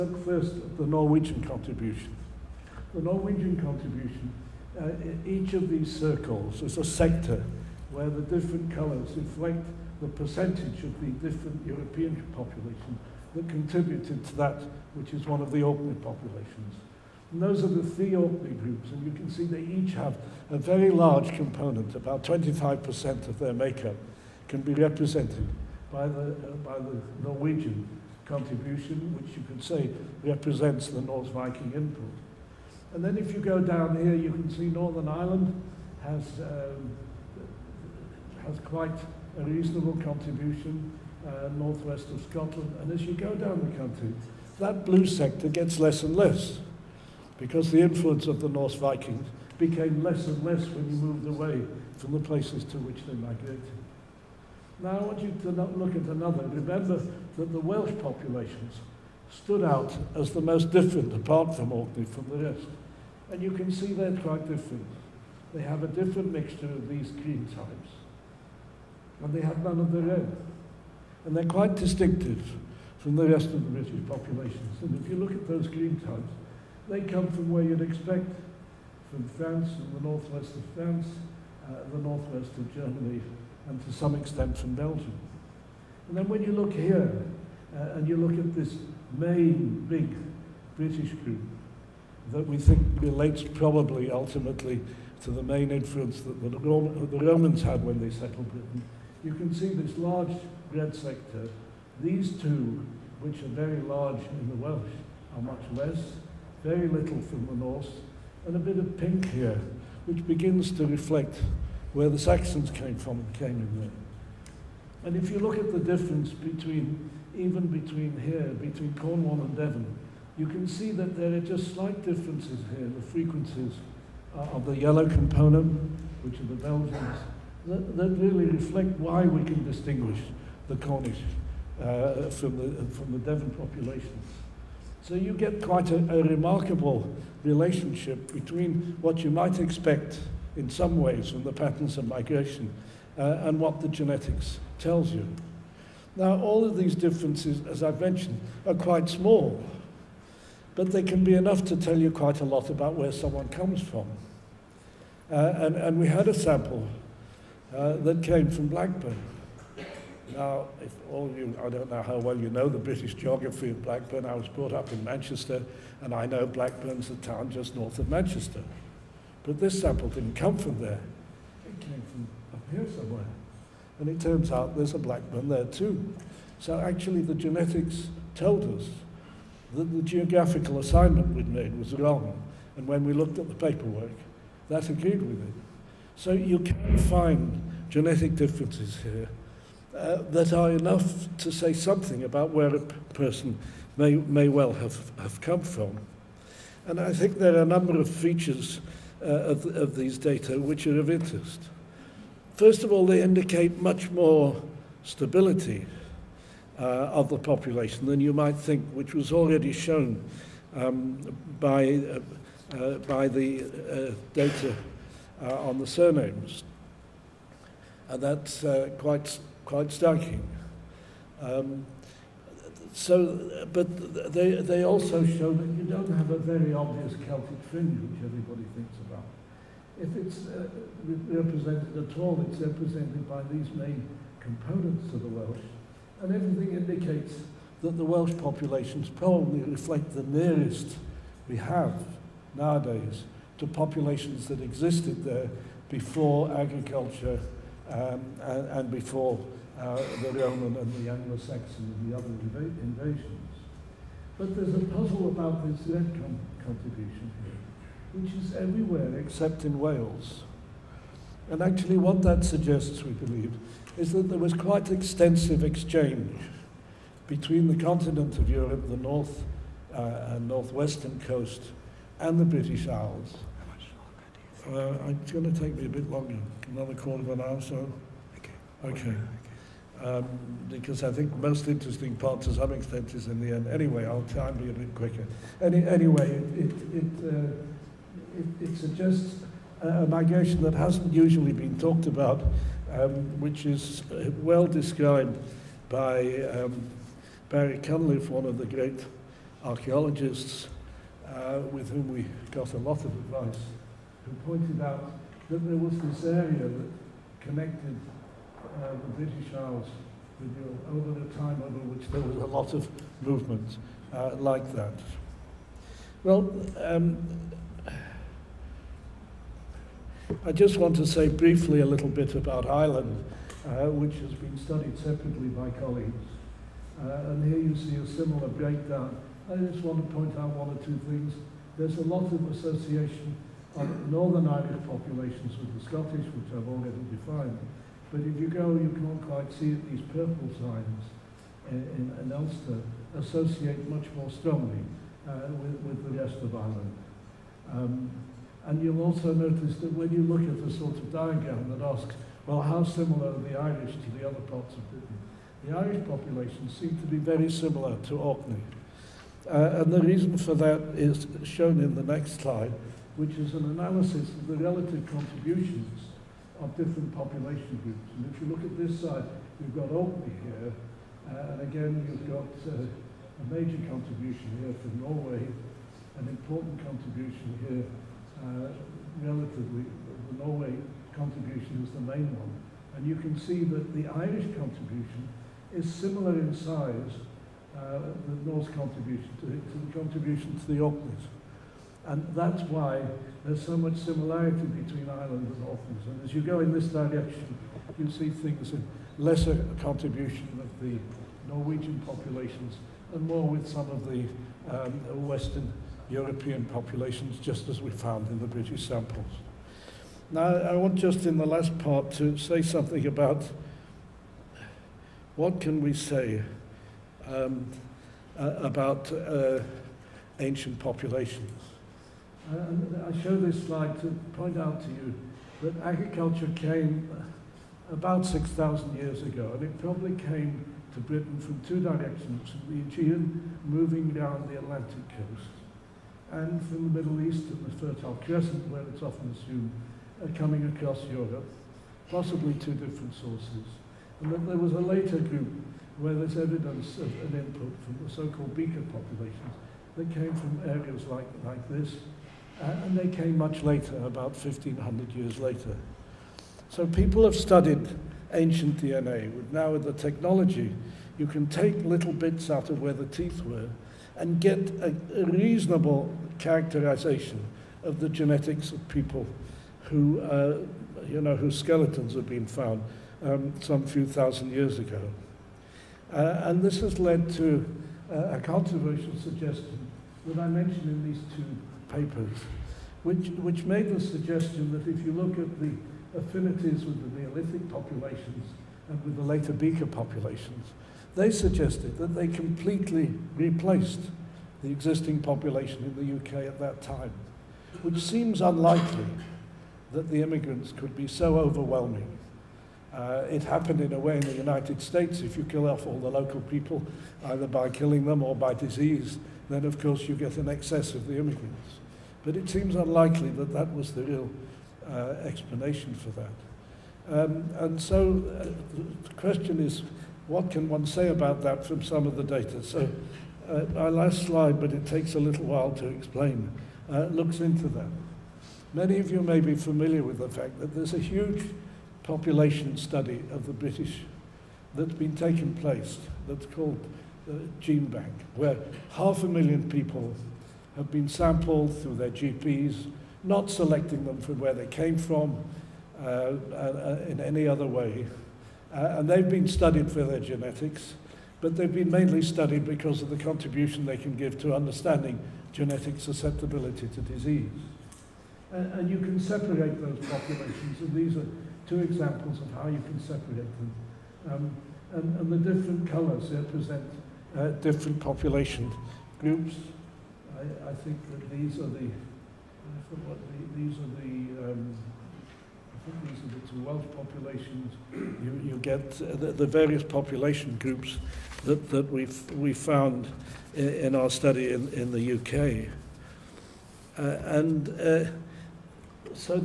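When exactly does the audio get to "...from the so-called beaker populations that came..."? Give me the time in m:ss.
7:27.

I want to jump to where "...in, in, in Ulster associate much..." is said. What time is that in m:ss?
5:41.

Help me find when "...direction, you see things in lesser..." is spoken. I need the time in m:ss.
6:36.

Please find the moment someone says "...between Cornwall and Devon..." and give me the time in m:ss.
1:58.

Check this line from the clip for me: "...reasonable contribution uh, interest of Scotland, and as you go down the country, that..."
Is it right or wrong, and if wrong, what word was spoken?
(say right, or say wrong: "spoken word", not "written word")
wrong: "northwest", not "interest".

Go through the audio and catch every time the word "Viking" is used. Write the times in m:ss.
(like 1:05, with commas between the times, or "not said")
0:31, 0:48.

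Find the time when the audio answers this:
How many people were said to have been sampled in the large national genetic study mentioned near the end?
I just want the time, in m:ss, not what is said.
8:58.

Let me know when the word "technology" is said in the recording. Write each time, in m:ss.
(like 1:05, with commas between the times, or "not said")
7:39.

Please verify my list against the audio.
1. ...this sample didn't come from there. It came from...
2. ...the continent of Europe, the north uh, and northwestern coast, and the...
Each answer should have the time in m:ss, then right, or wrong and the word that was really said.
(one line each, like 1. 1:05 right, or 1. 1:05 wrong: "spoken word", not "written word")
1. 2:49 right
2. 4:27 right.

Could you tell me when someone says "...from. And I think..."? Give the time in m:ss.
3:15.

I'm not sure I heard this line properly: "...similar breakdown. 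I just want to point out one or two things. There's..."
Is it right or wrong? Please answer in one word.
right.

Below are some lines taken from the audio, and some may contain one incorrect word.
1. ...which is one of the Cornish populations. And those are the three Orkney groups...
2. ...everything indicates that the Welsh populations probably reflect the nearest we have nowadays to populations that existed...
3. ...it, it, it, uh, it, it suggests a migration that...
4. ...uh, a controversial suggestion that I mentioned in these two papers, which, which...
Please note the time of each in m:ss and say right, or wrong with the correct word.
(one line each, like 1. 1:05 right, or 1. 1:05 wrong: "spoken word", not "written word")
1. 0:14 wrong: "Orkney", not "Cornish"
2. 3:56 right
3. 4:46 right
4. 7:58 right.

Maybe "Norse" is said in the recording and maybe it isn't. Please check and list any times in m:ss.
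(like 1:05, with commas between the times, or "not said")
0:31, 0:48, 6:28.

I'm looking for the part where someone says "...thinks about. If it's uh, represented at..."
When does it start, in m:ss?
3:48.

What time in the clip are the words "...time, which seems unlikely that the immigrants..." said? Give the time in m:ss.
8:16.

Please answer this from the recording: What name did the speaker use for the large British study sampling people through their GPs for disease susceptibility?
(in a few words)
gene bank.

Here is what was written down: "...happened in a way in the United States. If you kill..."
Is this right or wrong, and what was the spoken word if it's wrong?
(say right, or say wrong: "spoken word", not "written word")
right.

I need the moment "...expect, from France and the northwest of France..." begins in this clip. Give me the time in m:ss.
1:17.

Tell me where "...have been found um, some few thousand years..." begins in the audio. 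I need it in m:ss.
7:52.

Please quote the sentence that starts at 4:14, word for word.
But there's a puzzle about this red con contribution here, which is everywhere except in Wales.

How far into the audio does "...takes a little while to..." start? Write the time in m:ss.
8:44.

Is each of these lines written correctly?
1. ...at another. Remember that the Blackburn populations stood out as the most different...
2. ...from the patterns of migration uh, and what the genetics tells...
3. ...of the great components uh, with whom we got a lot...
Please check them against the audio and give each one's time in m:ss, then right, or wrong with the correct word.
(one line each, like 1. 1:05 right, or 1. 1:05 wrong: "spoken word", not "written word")
1. 0:55 wrong: "Welsh", not "Blackburn"
2. 2:21 right
3. 4:58 wrong: "archaeologists", not "components".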